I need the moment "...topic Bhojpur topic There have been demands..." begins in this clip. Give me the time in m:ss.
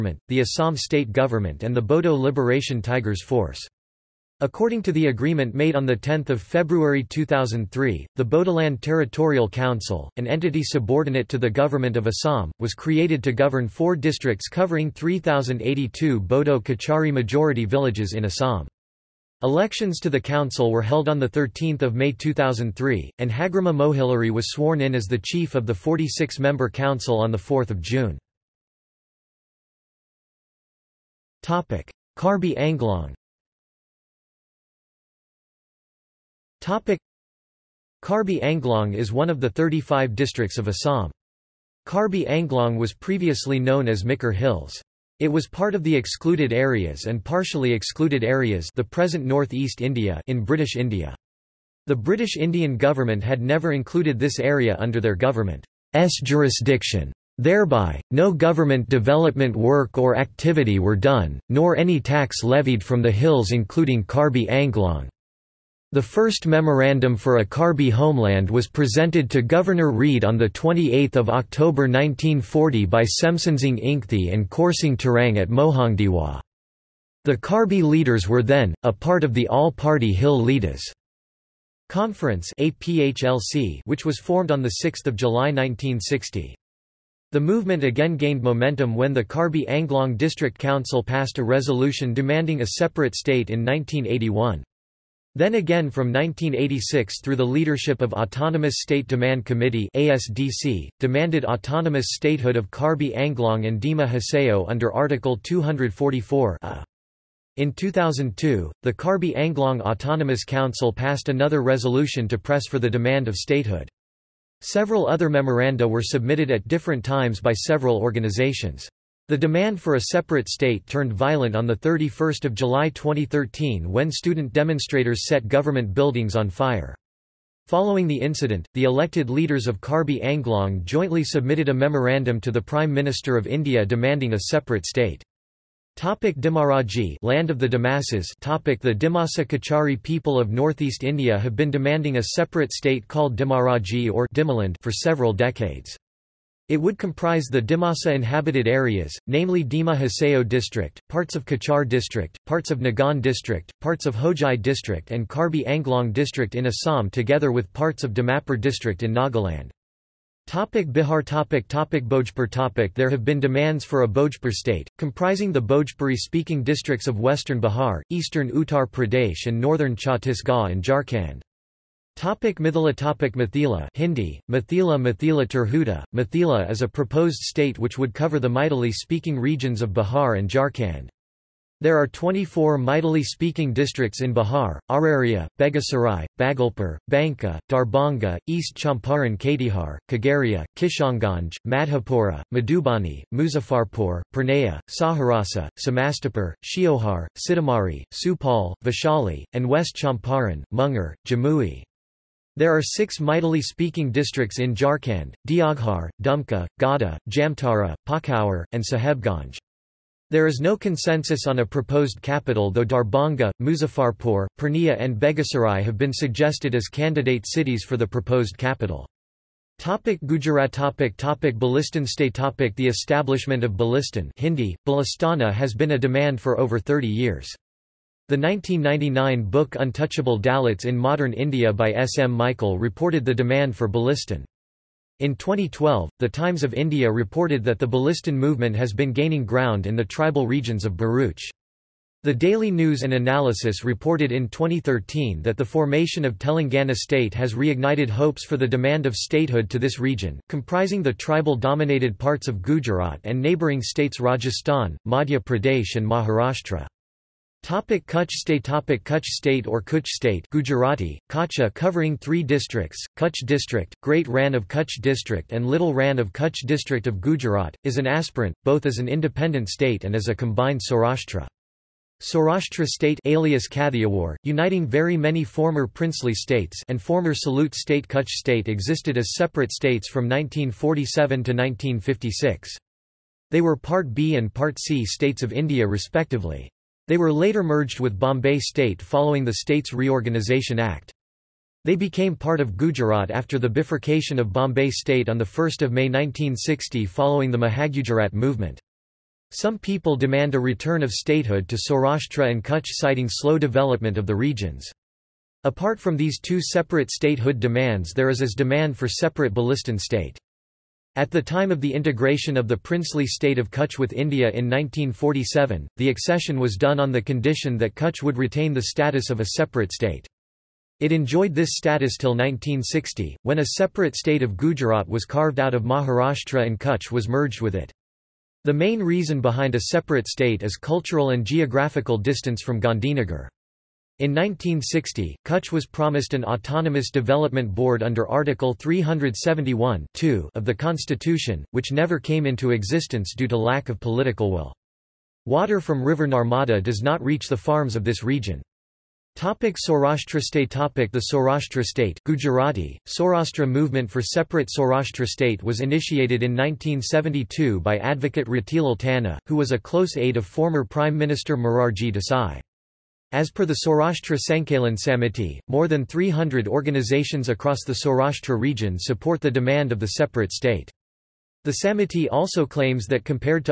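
2:41.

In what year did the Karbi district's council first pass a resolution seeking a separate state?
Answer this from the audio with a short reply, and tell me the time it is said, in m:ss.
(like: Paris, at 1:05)
1981, at 1:33.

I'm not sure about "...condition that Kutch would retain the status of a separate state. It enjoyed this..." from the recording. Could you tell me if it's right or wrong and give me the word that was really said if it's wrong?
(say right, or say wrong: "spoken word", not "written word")
right.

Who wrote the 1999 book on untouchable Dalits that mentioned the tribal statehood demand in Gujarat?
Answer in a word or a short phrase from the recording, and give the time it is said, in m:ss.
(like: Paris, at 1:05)
S. M. Michael, at 3:51.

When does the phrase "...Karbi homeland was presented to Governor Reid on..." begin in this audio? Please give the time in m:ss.
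1:07.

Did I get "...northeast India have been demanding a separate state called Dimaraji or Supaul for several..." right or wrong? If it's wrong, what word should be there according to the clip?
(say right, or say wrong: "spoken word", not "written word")
wrong: "Dimaland", not "Supaul".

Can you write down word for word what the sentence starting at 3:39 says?
Topic Gujarat topic topic Bhilistan state topic The establishment of Bhilistan Hindi, Balistana has been a demand for over 30 years.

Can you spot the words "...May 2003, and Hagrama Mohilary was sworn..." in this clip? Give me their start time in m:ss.
0:21.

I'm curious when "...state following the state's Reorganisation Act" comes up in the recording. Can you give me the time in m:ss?
4:48.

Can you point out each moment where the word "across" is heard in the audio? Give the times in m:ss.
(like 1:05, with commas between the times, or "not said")
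6:07.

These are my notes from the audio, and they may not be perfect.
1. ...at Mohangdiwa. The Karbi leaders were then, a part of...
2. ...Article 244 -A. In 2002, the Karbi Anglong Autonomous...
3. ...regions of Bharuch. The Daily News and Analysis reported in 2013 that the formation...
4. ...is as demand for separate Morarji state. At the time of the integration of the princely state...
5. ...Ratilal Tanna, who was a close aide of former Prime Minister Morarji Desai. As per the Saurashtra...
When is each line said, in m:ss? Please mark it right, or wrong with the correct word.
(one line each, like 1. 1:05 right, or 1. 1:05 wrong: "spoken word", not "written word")
1. 1:15 right
2. 1:44 right
3. 4:00 right
4. 5:08 wrong: "Bhilistan", not "Morarji"
5. 5:58 right.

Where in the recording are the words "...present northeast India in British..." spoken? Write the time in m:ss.
0:48.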